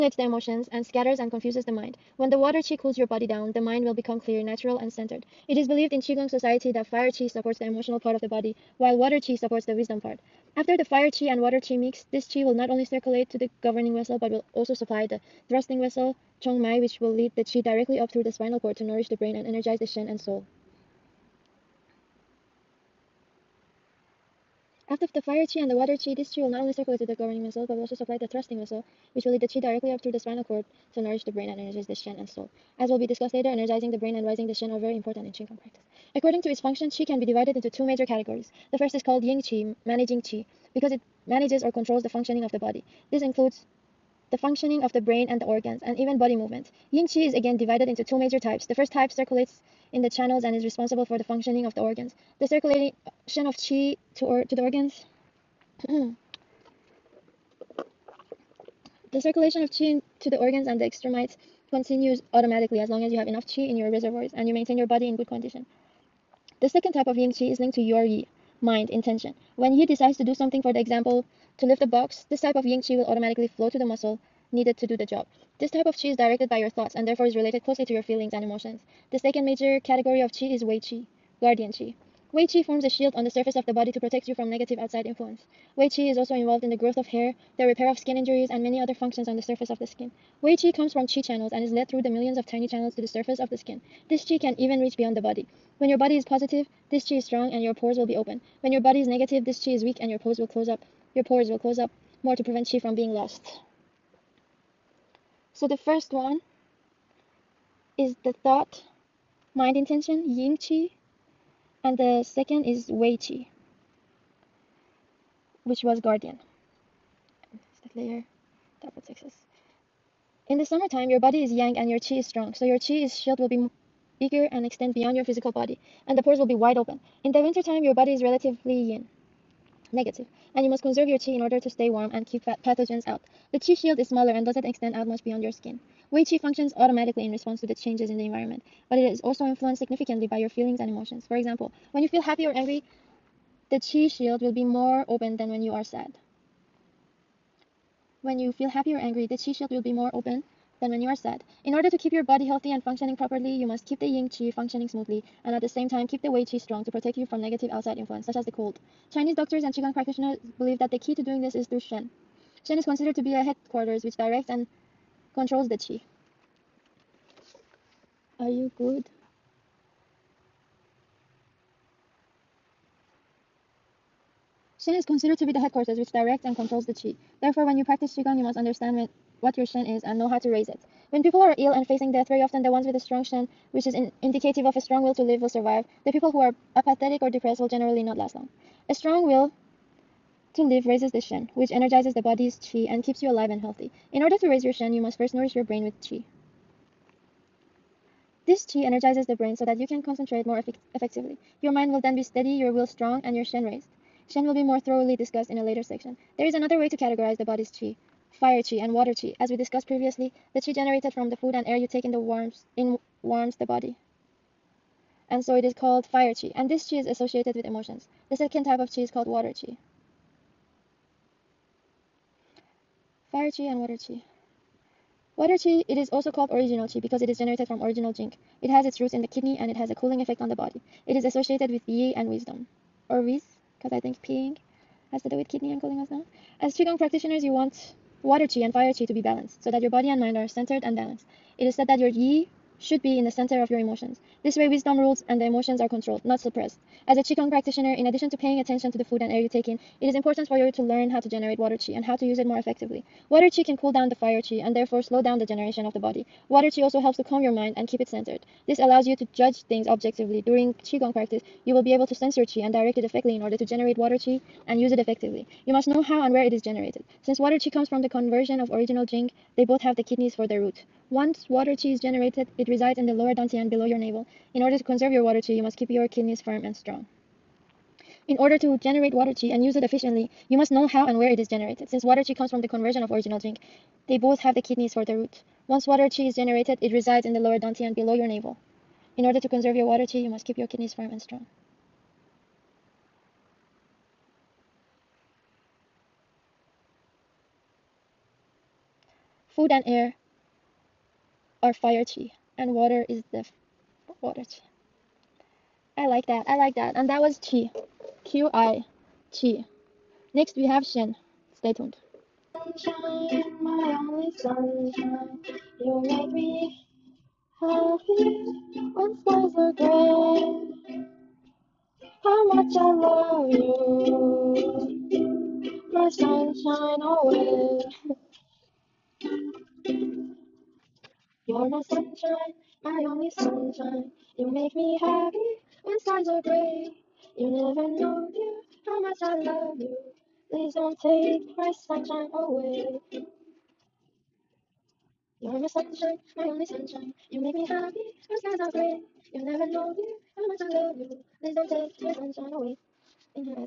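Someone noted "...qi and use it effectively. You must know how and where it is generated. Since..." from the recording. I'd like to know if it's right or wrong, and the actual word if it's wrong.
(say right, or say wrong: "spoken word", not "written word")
right.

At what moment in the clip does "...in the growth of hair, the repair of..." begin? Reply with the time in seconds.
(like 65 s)
86 s.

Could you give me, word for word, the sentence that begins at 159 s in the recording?
Chinese doctors and qigong practitioners believe that the key to doing this is through shen.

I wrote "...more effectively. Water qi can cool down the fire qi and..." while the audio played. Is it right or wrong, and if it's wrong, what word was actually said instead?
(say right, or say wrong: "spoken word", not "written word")
right.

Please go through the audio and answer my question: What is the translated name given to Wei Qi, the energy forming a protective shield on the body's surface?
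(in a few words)
guardian Qi.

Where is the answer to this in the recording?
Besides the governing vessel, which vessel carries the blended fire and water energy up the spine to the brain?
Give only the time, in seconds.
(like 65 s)
16 s.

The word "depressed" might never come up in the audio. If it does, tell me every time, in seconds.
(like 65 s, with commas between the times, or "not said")
187 s.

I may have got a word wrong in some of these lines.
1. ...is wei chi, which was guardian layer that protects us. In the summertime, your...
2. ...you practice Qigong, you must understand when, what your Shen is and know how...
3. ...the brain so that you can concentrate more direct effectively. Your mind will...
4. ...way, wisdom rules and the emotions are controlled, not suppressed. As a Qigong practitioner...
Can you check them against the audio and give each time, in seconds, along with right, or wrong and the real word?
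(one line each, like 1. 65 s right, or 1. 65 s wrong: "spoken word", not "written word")
1. 112 s right
2. 177 s right
3. 199 s wrong: "effect", not "direct"
4. 244 s right.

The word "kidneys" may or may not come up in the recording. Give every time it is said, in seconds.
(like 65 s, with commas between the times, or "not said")
229 s, 235 s, 270 s, 276 s, 284 s, 290 s.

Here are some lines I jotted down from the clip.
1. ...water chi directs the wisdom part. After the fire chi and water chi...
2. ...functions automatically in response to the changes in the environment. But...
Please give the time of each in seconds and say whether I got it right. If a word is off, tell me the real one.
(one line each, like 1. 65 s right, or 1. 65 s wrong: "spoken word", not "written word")
1. 8 s wrong: "supports", not "directs"
2. 136 s right.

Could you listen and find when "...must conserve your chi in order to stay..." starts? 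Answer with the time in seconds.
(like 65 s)
130 s.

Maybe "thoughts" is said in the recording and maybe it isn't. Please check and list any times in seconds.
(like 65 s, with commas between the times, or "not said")
76 s, 108 s.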